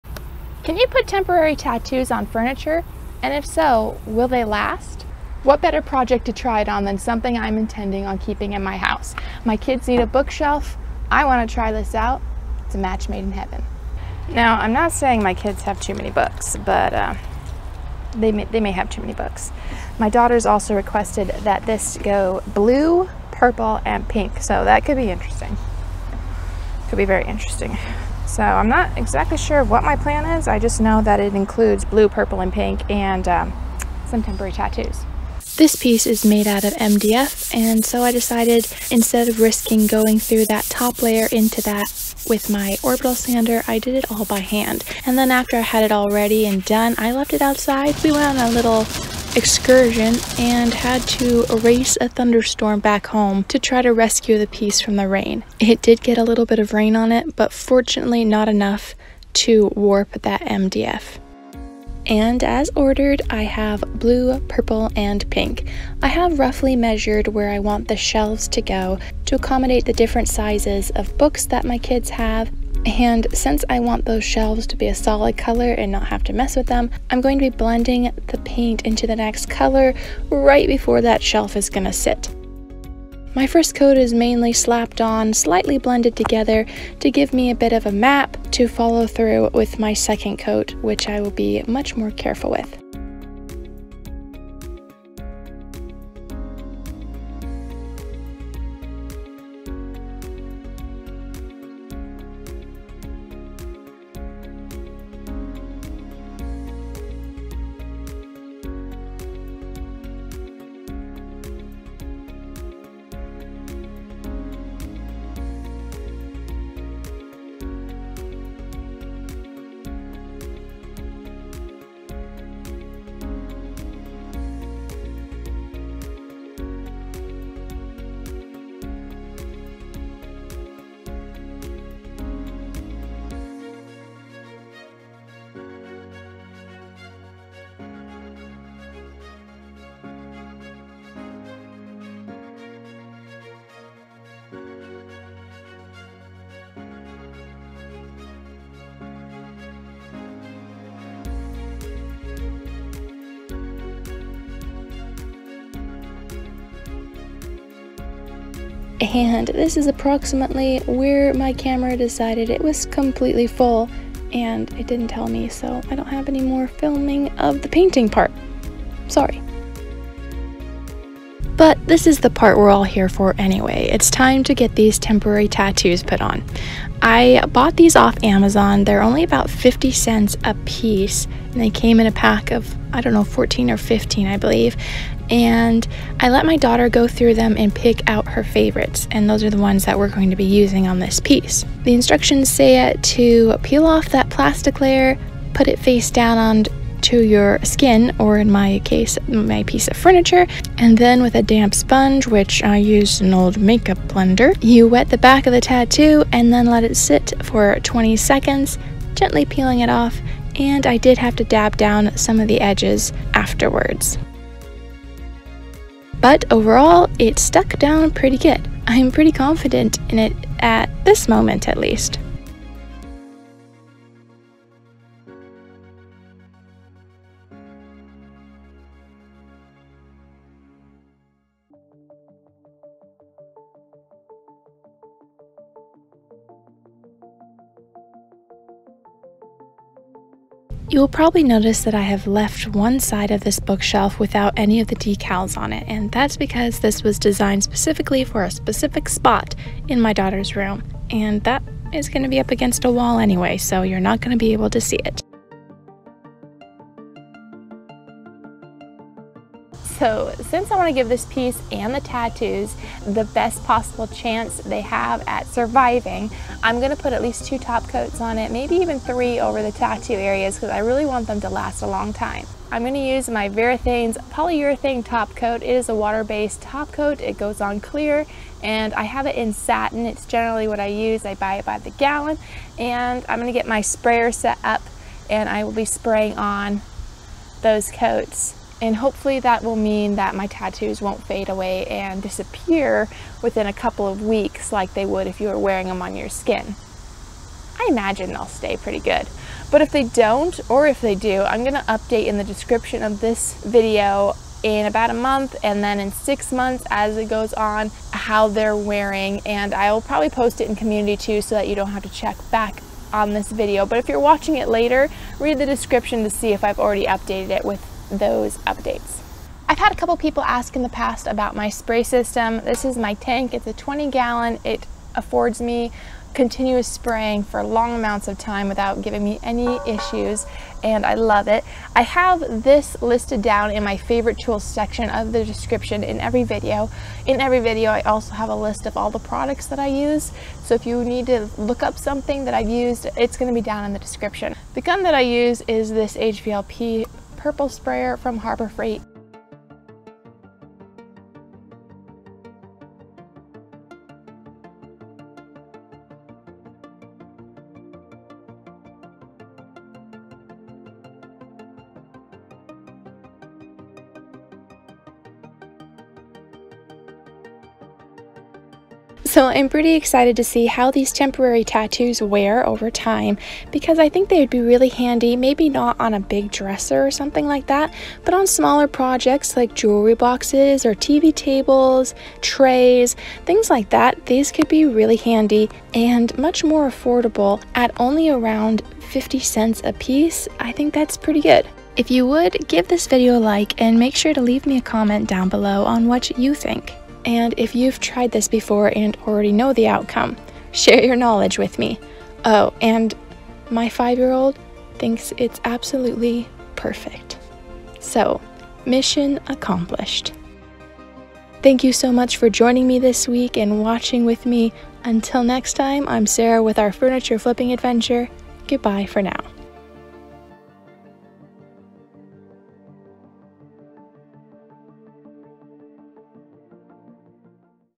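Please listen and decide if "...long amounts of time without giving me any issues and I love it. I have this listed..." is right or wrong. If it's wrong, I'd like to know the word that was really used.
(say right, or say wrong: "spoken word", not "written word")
right.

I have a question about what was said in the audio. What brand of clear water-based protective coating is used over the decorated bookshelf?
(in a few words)
Varathane.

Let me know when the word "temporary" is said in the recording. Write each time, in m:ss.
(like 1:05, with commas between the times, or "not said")
0:01, 0:34, 2:54, 6:11.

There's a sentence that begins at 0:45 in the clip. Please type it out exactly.
And then after I had it all ready and done, I left it outside.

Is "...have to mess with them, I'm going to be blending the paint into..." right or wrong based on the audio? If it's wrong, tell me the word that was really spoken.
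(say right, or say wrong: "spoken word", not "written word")
right.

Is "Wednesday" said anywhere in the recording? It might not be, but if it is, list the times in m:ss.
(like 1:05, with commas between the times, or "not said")
not said.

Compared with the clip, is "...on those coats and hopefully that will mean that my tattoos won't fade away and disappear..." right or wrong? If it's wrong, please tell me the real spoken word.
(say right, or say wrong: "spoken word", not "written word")
right.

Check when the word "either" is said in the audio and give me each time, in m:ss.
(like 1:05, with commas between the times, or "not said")
not said.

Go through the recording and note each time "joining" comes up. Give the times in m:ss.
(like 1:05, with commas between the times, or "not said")
6:52.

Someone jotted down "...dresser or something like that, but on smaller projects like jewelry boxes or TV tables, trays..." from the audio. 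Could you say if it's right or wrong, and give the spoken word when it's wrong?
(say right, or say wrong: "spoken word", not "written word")
right.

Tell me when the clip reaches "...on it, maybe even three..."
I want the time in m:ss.
4:28.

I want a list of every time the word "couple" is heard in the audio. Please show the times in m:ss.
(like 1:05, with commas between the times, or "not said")
4:53, 5:19.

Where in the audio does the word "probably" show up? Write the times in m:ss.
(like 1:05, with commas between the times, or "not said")
4:01, 5:10.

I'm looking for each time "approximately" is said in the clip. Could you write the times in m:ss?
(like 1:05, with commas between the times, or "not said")
2:39.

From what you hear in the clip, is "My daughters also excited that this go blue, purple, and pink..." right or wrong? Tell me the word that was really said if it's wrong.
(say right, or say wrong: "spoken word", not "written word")
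wrong: "requested", not "excited".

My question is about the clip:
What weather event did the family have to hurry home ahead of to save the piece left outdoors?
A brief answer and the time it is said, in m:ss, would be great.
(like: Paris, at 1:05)
Thunderstorm, at 0:52.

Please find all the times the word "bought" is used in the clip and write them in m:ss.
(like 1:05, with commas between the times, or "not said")
2:57.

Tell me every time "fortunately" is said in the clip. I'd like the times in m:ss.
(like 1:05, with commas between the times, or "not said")
0:57.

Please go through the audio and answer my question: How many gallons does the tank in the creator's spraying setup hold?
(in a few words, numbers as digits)
20.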